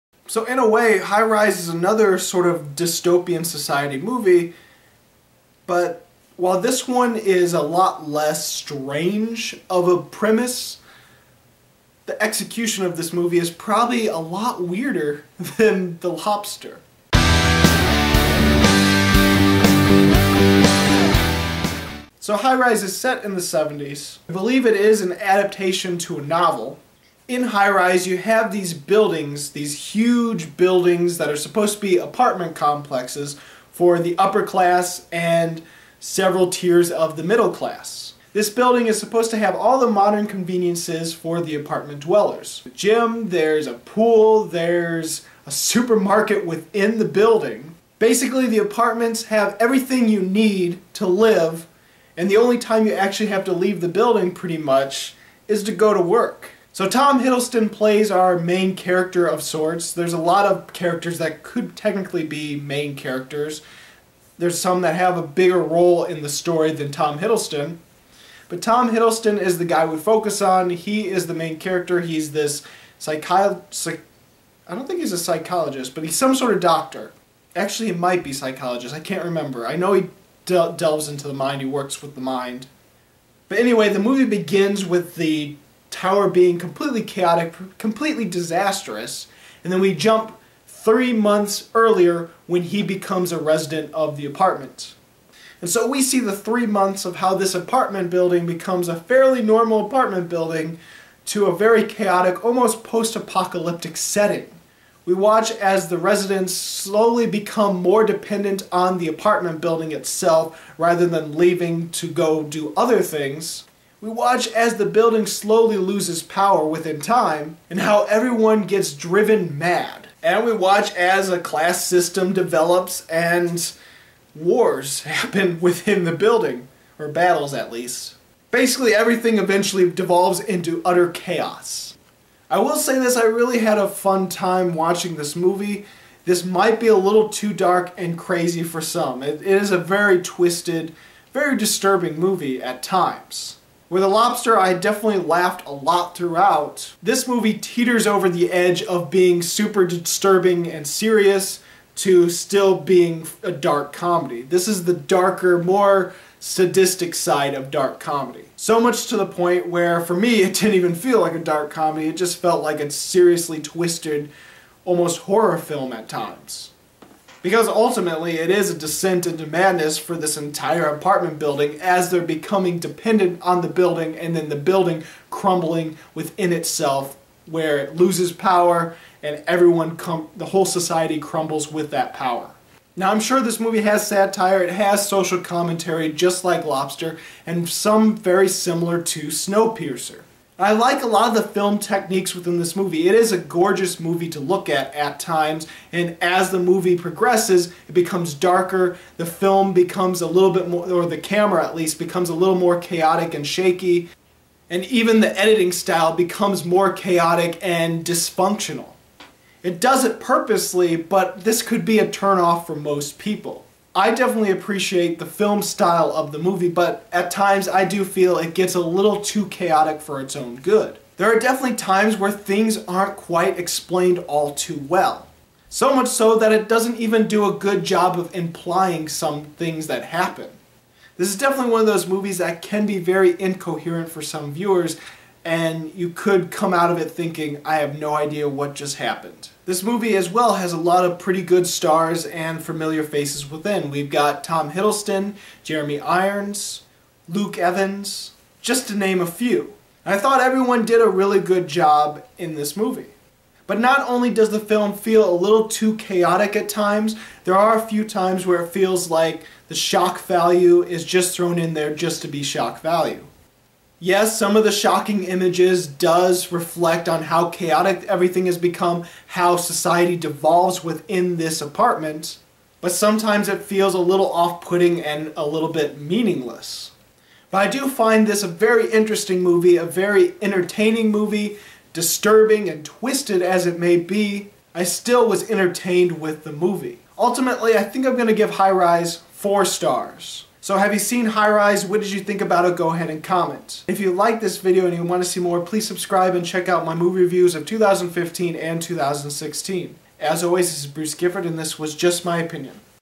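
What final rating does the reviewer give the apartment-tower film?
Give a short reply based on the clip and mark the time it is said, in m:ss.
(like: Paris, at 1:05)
4 stars, at 4:49.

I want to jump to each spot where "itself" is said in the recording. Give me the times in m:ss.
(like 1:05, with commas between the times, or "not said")
1:49, 2:56.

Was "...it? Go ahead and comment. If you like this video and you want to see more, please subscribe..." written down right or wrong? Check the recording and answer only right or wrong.
right.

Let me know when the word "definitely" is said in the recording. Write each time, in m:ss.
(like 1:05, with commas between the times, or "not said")
2:24, 3:34, 3:41, 3:51.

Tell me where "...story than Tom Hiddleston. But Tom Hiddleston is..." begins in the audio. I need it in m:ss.
1:06.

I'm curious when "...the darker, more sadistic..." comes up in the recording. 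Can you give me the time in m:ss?
2:34.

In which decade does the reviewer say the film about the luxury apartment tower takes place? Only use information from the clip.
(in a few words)
the 70s.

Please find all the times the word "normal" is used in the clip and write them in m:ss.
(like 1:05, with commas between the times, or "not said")
1:39.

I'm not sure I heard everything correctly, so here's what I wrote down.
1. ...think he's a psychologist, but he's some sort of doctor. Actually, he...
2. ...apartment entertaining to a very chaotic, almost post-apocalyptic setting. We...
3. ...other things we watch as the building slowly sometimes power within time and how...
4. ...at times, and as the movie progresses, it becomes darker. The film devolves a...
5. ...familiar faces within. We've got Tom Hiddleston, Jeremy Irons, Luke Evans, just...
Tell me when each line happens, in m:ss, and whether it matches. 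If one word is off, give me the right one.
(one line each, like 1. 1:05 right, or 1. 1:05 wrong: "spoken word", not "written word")
1. 1:14 right
2. 1:39 wrong: "building", not "entertaining"
3. 1:52 wrong: "loses", not "sometimes"
4. 3:14 wrong: "becomes", not "devolves"
5. 4:02 right.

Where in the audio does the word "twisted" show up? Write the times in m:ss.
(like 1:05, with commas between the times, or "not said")
2:20, 2:43, 4:42.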